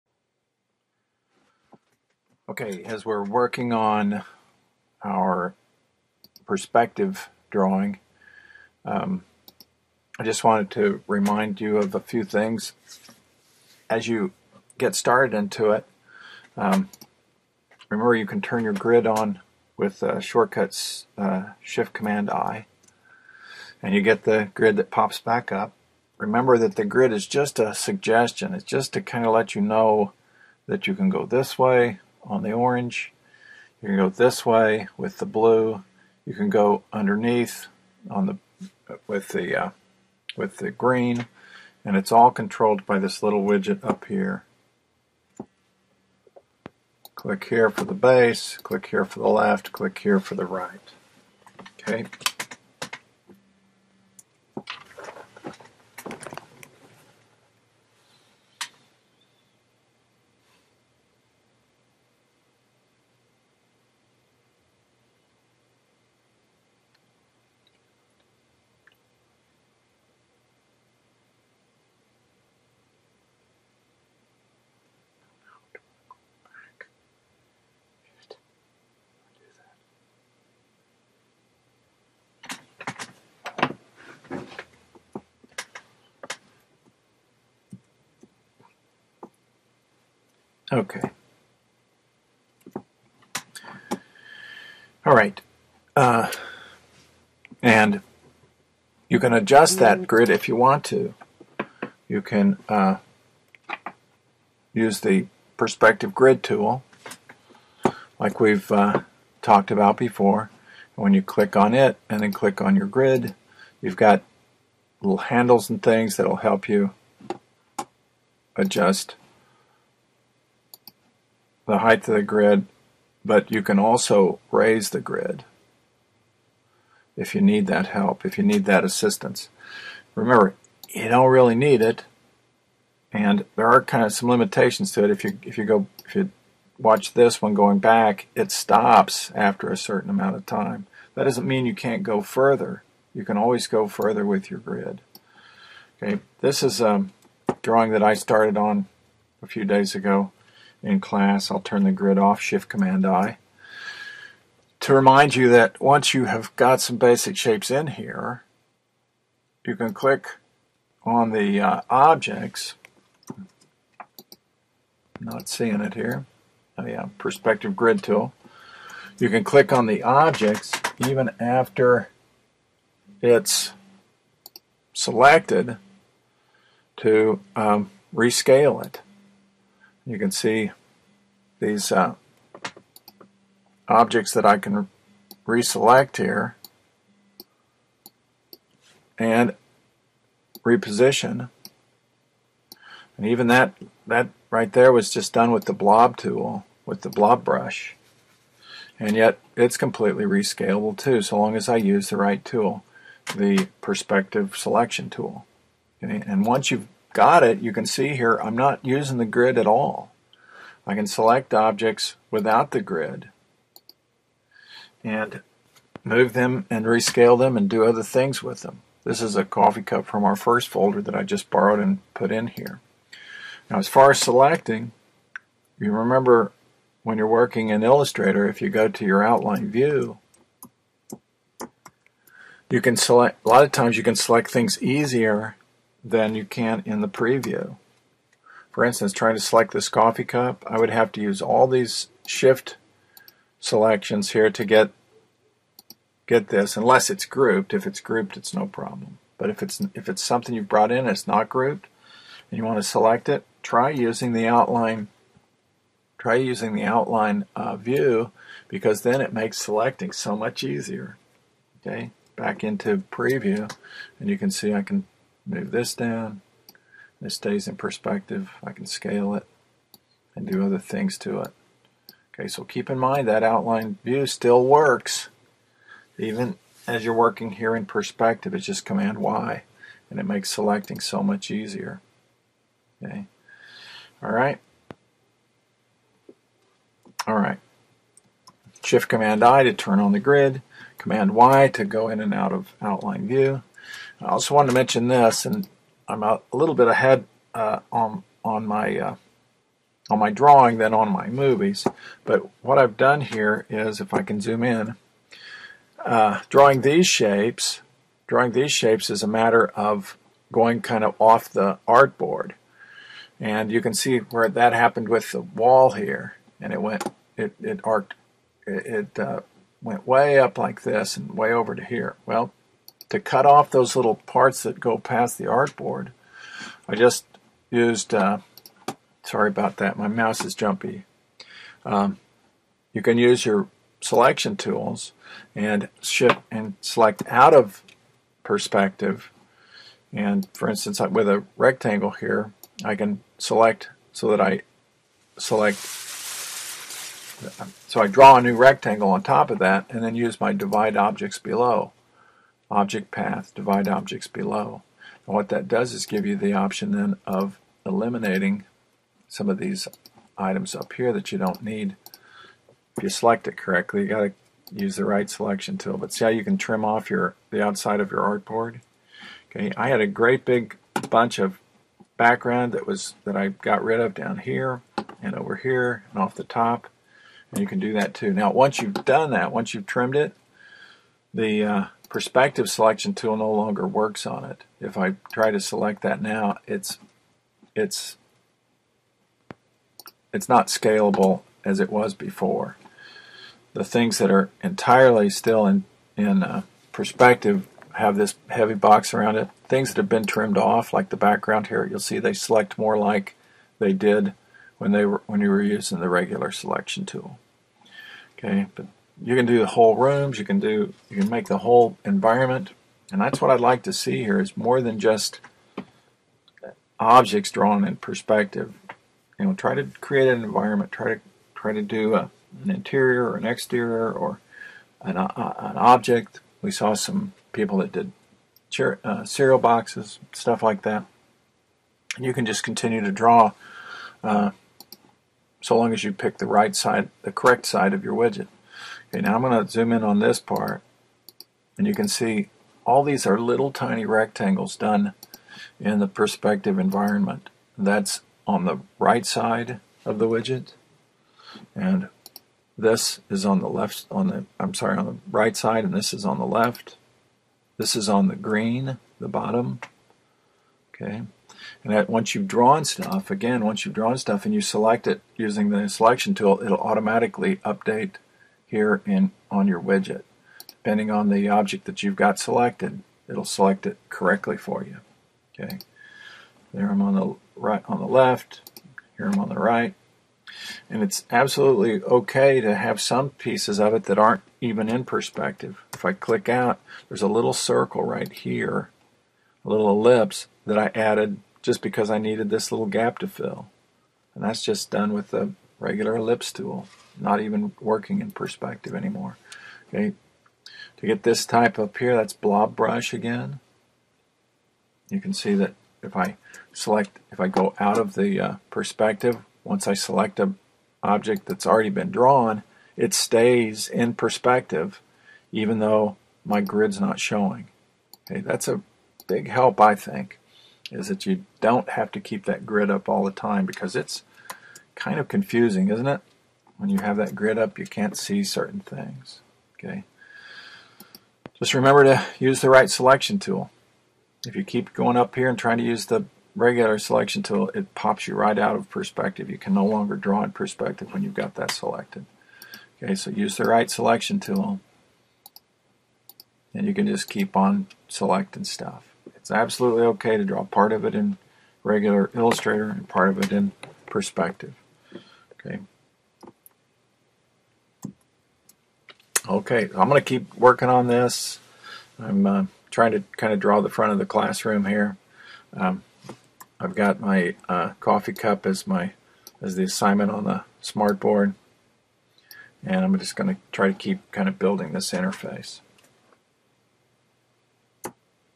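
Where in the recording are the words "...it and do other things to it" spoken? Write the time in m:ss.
4:29.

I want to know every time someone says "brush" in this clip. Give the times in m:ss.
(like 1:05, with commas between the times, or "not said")
3:17, 8:22.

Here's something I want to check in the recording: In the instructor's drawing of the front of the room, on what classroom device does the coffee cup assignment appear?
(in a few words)
Smartboard.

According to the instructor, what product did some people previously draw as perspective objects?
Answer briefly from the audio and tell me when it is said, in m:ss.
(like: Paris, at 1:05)
Cereal boxes, at 7:09.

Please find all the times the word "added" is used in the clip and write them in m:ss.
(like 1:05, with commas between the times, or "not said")
8:10.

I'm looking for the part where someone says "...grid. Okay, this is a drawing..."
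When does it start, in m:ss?
2:24.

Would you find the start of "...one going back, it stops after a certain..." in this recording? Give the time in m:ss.
2:17.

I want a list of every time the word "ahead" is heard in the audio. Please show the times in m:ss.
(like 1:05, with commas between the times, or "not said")
4:56.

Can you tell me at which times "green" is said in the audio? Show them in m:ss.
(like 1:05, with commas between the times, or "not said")
0:40, 7:38.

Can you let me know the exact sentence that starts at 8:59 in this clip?
You can no longer draw in perspective when you've got that selected.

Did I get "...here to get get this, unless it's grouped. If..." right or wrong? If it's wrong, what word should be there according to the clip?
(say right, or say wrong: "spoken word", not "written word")
right.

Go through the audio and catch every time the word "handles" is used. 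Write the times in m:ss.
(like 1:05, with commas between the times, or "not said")
1:55.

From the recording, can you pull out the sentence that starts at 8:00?
And it's absolutely okay to have some pieces of it that aren't even in perspective.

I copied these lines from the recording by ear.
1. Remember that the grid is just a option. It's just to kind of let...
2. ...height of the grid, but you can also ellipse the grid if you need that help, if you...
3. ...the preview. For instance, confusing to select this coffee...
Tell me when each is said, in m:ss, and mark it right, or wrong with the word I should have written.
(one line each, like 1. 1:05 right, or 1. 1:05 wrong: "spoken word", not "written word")
1. 0:26 wrong: "suggestion", not "option"
2. 2:01 wrong: "raise", not "ellipse"
3. 3:57 wrong: "trying", not "confusing".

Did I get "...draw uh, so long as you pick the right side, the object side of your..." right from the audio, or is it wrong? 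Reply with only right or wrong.
wrong.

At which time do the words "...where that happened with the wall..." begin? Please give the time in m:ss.
5:14.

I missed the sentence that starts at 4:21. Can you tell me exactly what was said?
Okay, back into preview and you can see I can move this down.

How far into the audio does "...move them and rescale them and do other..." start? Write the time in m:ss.
3:36.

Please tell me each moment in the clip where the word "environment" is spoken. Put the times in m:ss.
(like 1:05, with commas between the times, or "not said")
6:52, 7:00, 7:26.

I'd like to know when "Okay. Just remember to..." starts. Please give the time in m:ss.
8:49.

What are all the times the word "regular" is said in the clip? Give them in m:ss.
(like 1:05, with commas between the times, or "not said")
6:46, 8:15, 8:56, 9:11.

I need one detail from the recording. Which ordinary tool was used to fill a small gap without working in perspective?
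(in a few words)
Ellipse tool.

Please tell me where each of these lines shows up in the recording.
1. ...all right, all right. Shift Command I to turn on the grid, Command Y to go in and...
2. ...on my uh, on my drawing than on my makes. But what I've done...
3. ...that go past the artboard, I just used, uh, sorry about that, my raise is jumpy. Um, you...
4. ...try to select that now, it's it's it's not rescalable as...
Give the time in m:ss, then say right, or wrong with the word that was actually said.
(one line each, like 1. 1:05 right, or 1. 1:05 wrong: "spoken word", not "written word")
1. 4:44 right
2. 4:58 wrong: "movies", not "makes"
3. 5:24 wrong: "mouse", not "raise"
4. 6:25 wrong: "scalable", not "rescalable".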